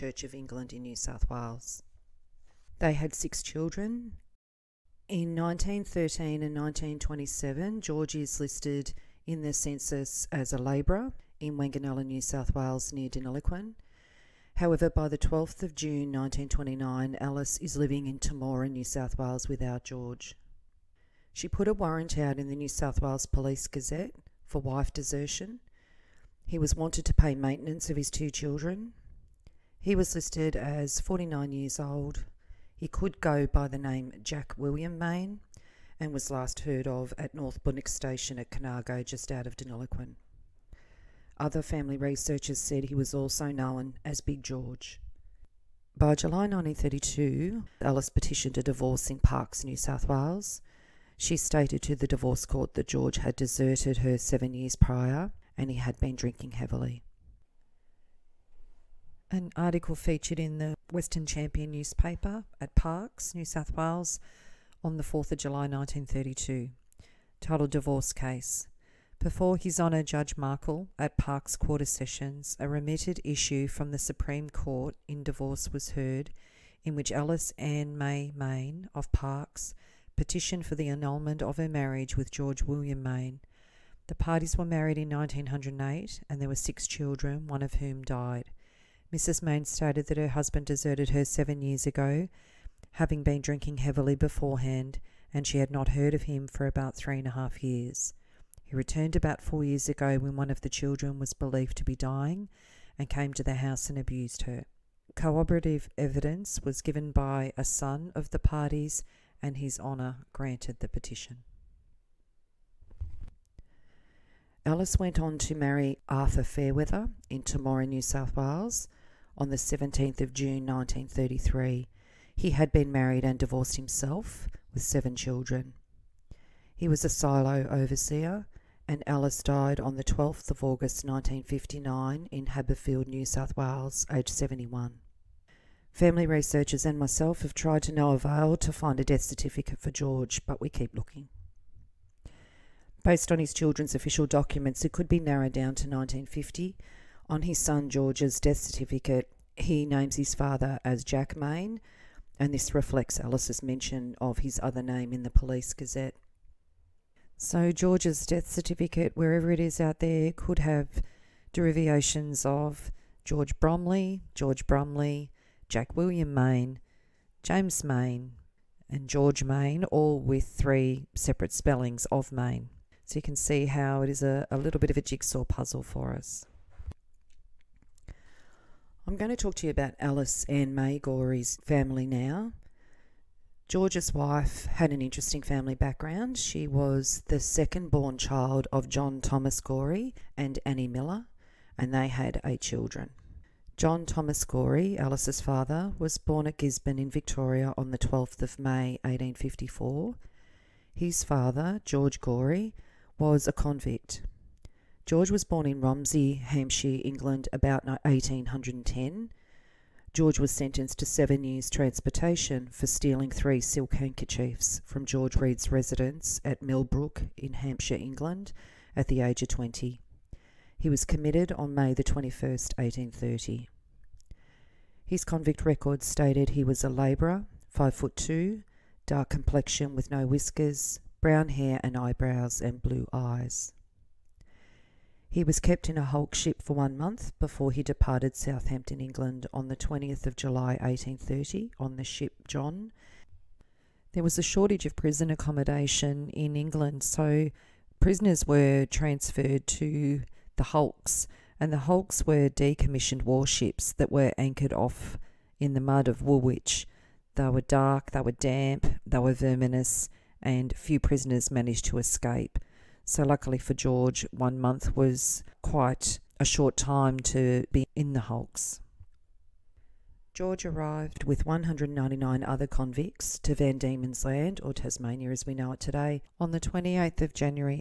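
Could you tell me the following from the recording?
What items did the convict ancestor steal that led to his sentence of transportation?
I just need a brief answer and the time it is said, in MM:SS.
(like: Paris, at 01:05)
Three silk handkerchiefs, at 03:33.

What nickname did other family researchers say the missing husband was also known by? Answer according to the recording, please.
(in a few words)
Big George.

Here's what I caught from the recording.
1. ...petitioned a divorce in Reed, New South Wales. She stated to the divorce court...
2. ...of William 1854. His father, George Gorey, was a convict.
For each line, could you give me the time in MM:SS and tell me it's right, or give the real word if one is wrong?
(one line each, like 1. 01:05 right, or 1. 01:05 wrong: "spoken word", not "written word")
1. 00:48 wrong: "Parkes", not "Reed"
2. 03:18 wrong: "May", not "William".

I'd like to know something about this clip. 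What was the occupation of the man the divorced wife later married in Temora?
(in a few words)
Silo overseer.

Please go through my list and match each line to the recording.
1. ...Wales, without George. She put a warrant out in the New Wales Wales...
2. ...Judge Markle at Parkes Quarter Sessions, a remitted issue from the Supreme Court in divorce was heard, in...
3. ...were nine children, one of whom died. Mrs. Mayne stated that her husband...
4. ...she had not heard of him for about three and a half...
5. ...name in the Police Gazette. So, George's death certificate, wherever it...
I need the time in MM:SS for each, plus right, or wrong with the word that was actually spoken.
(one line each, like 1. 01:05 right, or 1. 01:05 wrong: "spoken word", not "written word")
1. 00:19 wrong: "South", not "Wales"
2. 01:10 right
3. 01:26 wrong: "six", not "nine"
4. 01:35 right
5. 02:34 right.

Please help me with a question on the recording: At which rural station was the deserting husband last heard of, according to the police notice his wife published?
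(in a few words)
North Boonoke Station.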